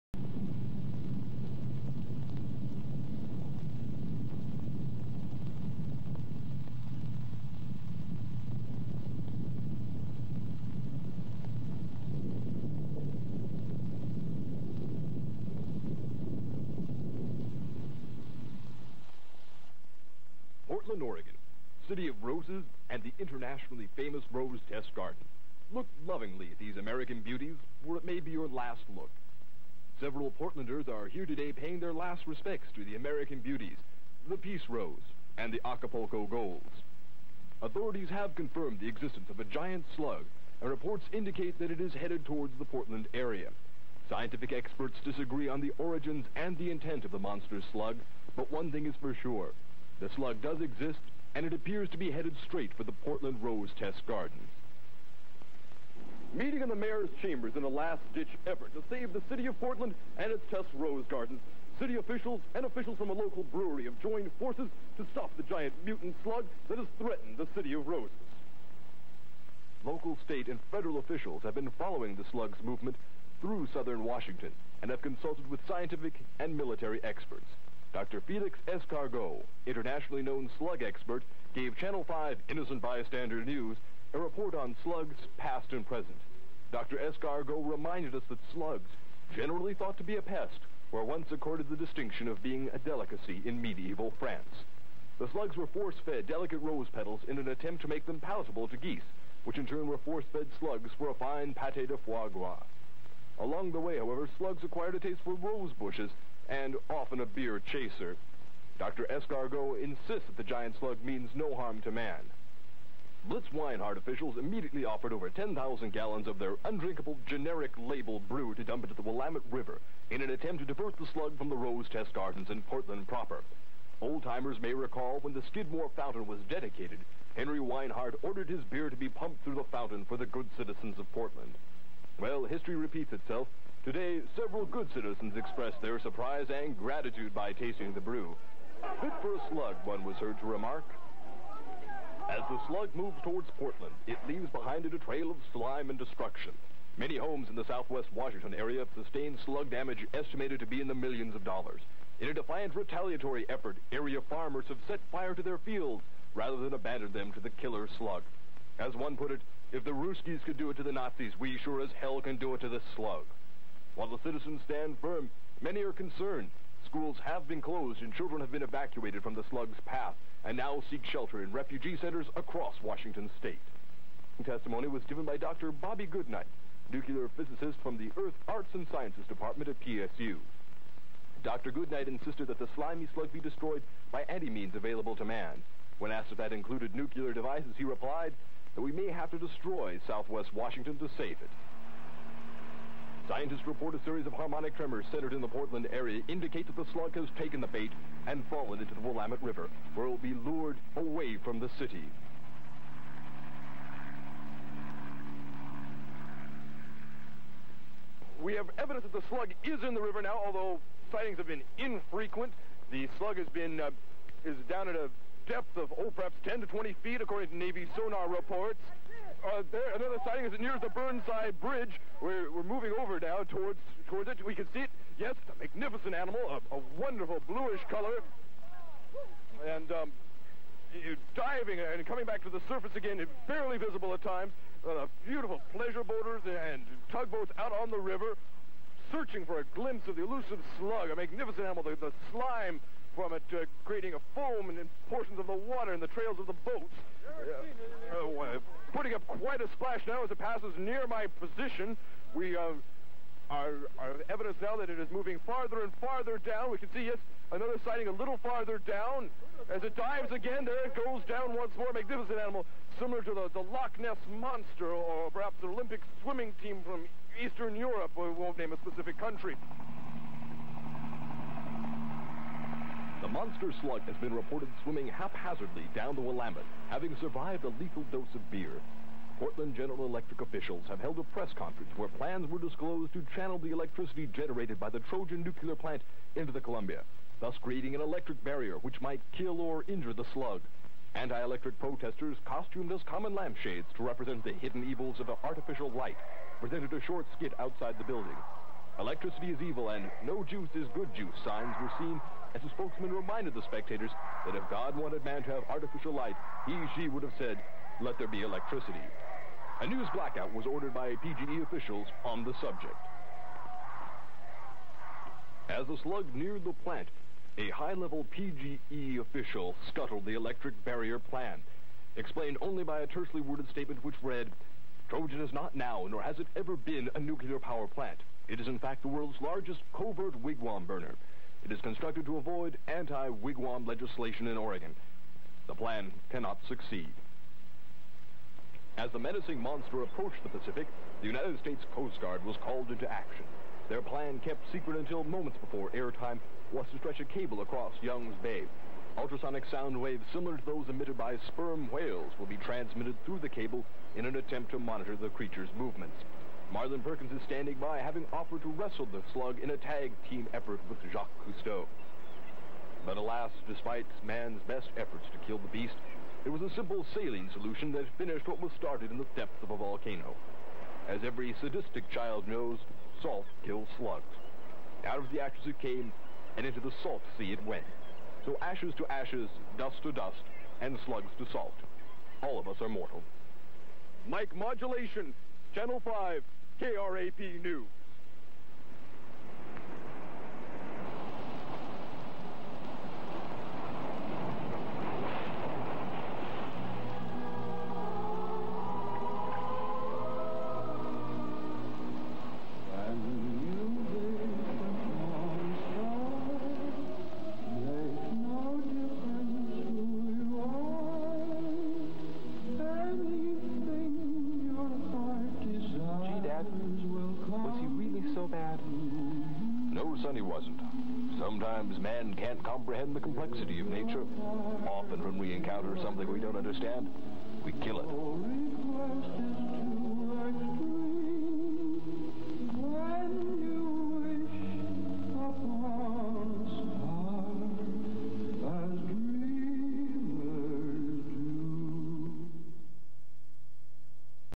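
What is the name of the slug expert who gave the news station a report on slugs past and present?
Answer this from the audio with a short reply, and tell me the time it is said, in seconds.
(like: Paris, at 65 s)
Dr. Felix Escargot, at 77 s.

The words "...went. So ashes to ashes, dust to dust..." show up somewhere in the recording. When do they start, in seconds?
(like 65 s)
377 s.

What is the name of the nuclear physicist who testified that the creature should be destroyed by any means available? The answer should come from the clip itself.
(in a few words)
Dr. Bobby Goodnight.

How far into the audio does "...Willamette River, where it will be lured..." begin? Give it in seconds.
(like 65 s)
199 s.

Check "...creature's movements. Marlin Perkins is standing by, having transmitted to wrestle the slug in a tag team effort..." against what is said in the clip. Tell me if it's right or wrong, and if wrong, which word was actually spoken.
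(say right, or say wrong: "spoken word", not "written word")
wrong: "offered", not "transmitted".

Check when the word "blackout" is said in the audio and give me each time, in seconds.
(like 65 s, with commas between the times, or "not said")
310 s.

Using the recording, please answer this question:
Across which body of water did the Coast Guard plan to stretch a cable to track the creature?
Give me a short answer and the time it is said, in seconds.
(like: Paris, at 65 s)
Young's Bay, at 348 s.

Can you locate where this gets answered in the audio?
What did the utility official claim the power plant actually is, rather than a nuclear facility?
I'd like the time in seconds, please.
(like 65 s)
329 s.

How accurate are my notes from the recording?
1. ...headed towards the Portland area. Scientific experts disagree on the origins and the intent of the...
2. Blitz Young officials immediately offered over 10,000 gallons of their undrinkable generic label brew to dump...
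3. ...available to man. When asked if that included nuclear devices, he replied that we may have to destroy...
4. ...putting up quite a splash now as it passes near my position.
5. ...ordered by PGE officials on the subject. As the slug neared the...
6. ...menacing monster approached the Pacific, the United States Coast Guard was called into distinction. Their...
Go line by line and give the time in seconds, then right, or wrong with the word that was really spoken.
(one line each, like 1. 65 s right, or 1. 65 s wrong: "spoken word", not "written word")
1. 41 s right
2. 113 s wrong: "Weinhard", not "Young"
3. 184 s right
4. 248 s right
5. 310 s right
6. 339 s wrong: "action", not "distinction".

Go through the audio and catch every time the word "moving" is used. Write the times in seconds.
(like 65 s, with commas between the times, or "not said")
222 s, 255 s.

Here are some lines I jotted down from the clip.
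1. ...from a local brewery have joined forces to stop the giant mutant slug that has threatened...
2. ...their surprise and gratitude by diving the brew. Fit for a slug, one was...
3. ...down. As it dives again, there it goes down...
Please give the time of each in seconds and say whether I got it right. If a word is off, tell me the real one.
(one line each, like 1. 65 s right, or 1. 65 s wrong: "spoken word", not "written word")
1. 62 s right
2. 135 s wrong: "tasting", not "diving"
3. 258 s right.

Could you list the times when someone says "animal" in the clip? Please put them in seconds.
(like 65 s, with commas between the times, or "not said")
226 s, 241 s, 262 s.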